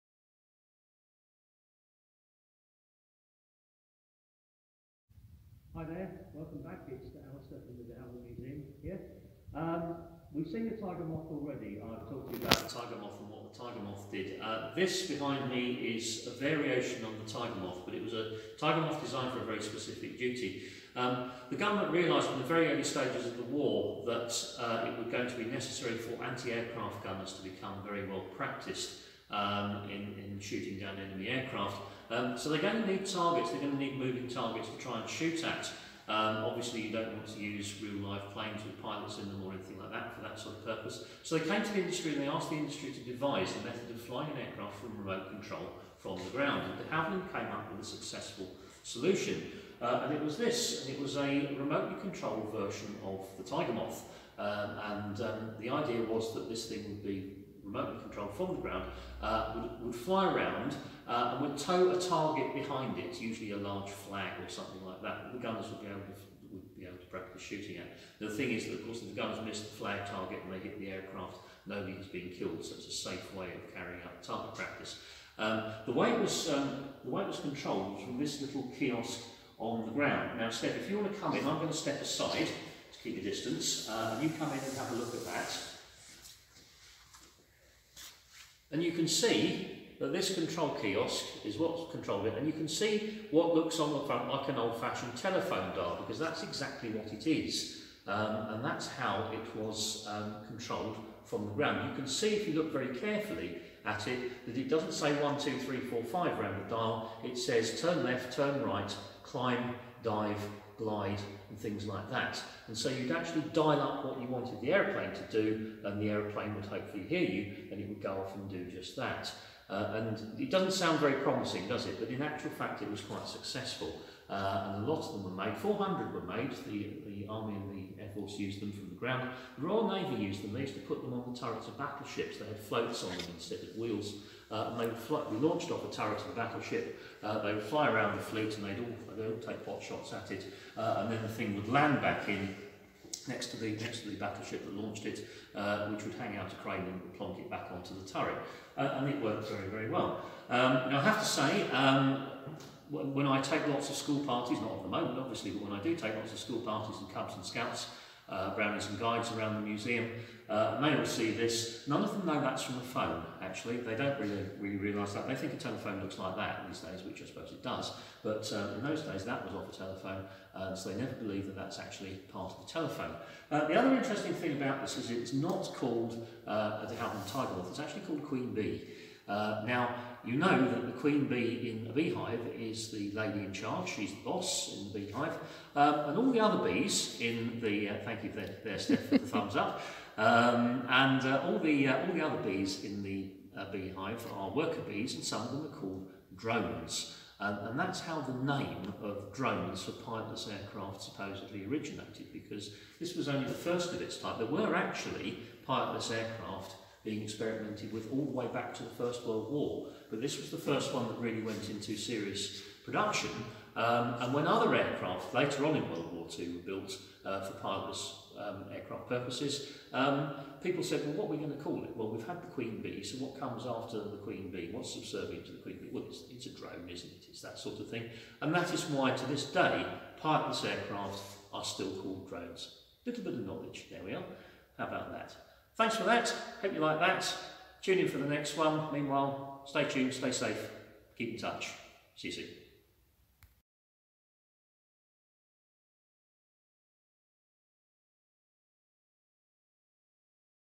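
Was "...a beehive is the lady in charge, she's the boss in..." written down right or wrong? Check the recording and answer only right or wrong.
right.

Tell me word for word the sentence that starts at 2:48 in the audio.
But um, in those days, that was off a telephone, uh, so they never believe that that's actually part of the telephone.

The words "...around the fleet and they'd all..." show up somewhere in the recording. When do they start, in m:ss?
2:17.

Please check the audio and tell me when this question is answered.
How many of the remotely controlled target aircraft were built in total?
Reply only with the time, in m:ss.
2:05.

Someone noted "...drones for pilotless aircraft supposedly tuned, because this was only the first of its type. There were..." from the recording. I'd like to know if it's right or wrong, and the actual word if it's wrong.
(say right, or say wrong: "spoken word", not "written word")
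wrong: "originated", not "tuned".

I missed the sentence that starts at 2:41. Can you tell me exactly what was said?
None of them know that's from a phone, actually.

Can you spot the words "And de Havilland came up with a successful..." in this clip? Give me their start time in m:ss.
0:46.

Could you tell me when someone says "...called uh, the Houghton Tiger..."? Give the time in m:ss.
2:55.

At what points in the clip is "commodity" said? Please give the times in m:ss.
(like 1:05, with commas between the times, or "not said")
not said.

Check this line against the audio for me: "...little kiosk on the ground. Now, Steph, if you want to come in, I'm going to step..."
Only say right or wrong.
right.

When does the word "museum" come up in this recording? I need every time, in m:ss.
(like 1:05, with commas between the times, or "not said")
0:08, 2:39.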